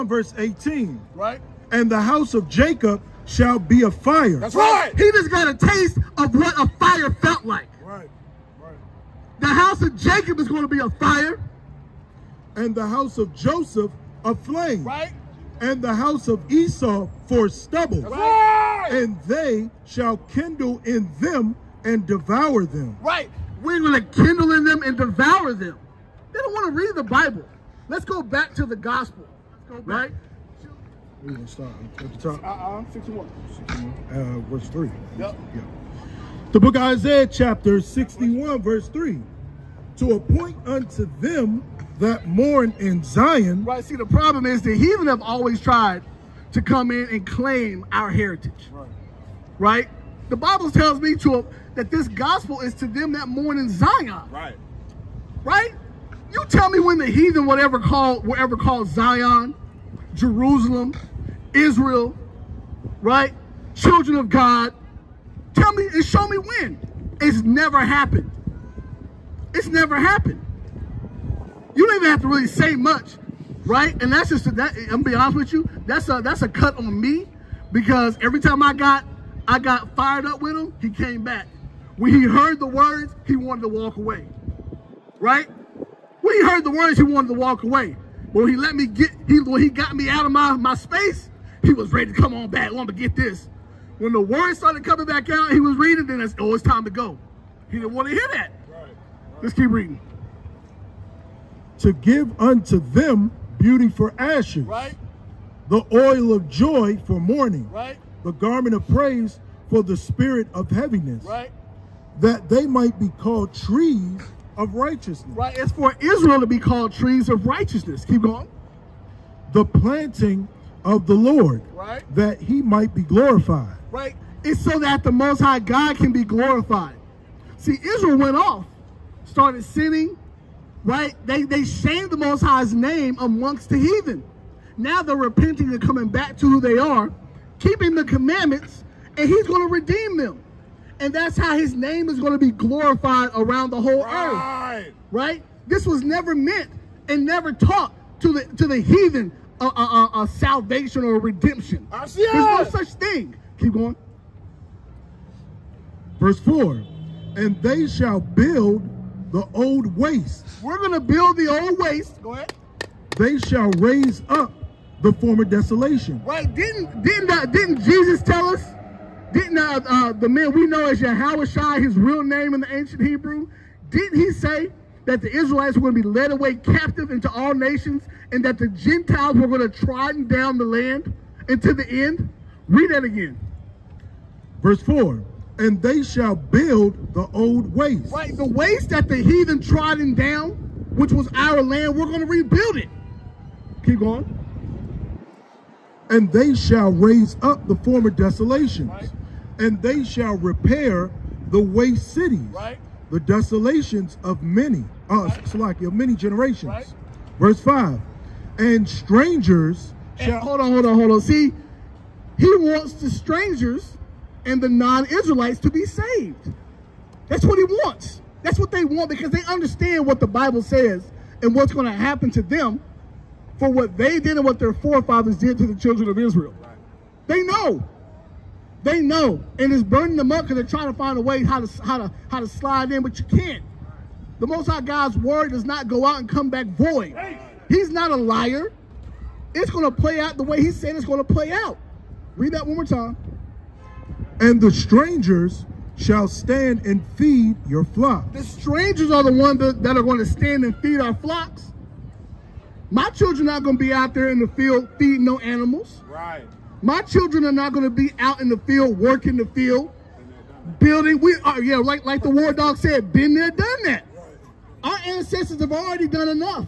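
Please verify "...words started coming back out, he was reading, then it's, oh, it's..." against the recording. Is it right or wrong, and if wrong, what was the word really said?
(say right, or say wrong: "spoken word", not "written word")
right.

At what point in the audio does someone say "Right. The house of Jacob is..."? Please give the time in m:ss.
0:08.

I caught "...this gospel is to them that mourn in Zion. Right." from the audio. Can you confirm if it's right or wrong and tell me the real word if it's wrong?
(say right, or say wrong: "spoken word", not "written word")
right.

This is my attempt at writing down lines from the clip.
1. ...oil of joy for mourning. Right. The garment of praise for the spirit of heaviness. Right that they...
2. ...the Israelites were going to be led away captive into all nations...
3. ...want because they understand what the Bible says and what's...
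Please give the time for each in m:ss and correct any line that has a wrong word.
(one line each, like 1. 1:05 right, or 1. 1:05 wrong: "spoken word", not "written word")
1. 1:45 right
2. 2:55 right
3. 3:38 right.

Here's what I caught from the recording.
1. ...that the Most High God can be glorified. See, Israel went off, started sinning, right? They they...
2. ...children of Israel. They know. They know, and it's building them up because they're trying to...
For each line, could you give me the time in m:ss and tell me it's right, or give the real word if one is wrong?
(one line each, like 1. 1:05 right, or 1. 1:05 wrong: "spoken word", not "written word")
1. 2:04 right
2. 3:45 wrong: "burning", not "building".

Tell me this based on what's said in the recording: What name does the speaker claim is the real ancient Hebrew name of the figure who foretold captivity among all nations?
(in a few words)
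Yahushua.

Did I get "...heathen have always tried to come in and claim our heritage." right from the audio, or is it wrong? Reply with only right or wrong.
right.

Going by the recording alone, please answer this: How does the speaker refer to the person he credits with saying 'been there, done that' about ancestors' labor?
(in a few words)
the war dog.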